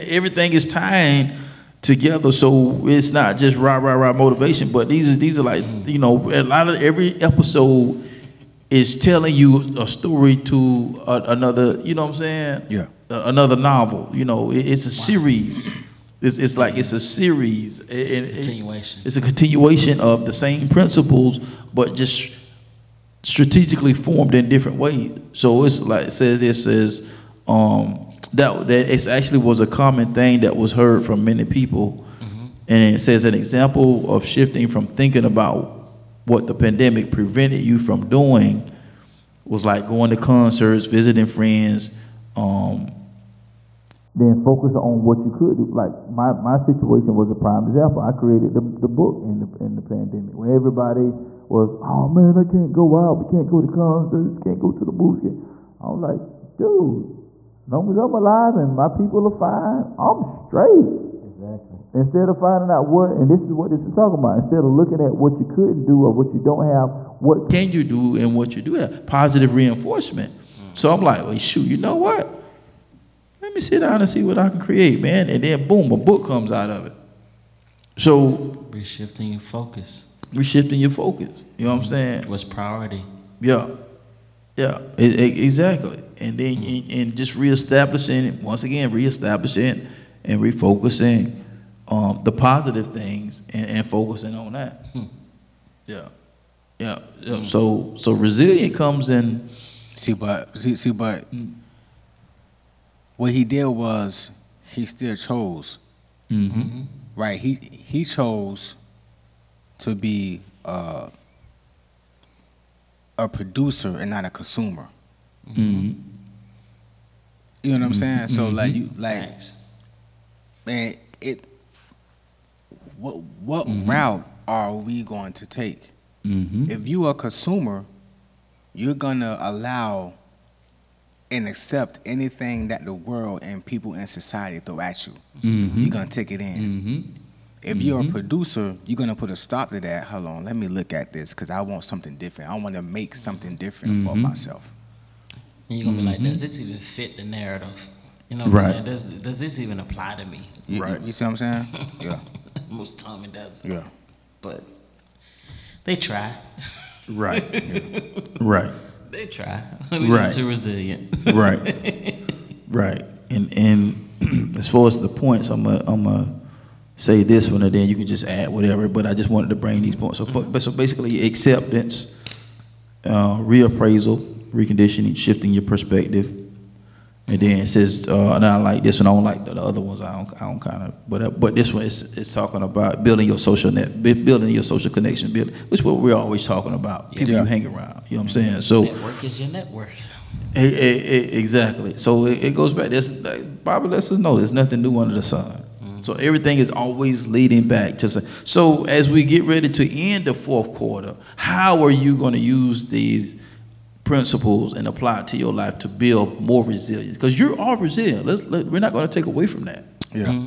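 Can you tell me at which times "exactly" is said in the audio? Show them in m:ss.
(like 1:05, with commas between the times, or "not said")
1:01, 1:25, 3:11.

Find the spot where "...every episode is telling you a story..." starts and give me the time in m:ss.
0:06.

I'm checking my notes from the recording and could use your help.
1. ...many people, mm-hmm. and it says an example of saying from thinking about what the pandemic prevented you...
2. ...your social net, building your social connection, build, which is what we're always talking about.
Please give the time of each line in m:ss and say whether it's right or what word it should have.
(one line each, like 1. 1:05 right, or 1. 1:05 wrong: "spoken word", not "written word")
1. 0:31 wrong: "shifting", not "saying"
2. 3:03 right.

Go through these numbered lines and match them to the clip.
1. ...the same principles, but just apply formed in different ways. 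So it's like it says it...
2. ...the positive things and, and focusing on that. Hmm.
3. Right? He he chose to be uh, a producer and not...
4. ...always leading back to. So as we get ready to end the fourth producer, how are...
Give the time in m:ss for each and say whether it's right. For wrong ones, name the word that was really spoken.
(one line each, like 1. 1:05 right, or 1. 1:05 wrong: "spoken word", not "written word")
1. 0:20 wrong: "strategically", not "apply"
2. 1:32 right
3. 1:47 right
4. 3:16 wrong: "quarter", not "producer".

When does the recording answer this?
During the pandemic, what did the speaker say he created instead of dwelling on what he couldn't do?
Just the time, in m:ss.
0:48.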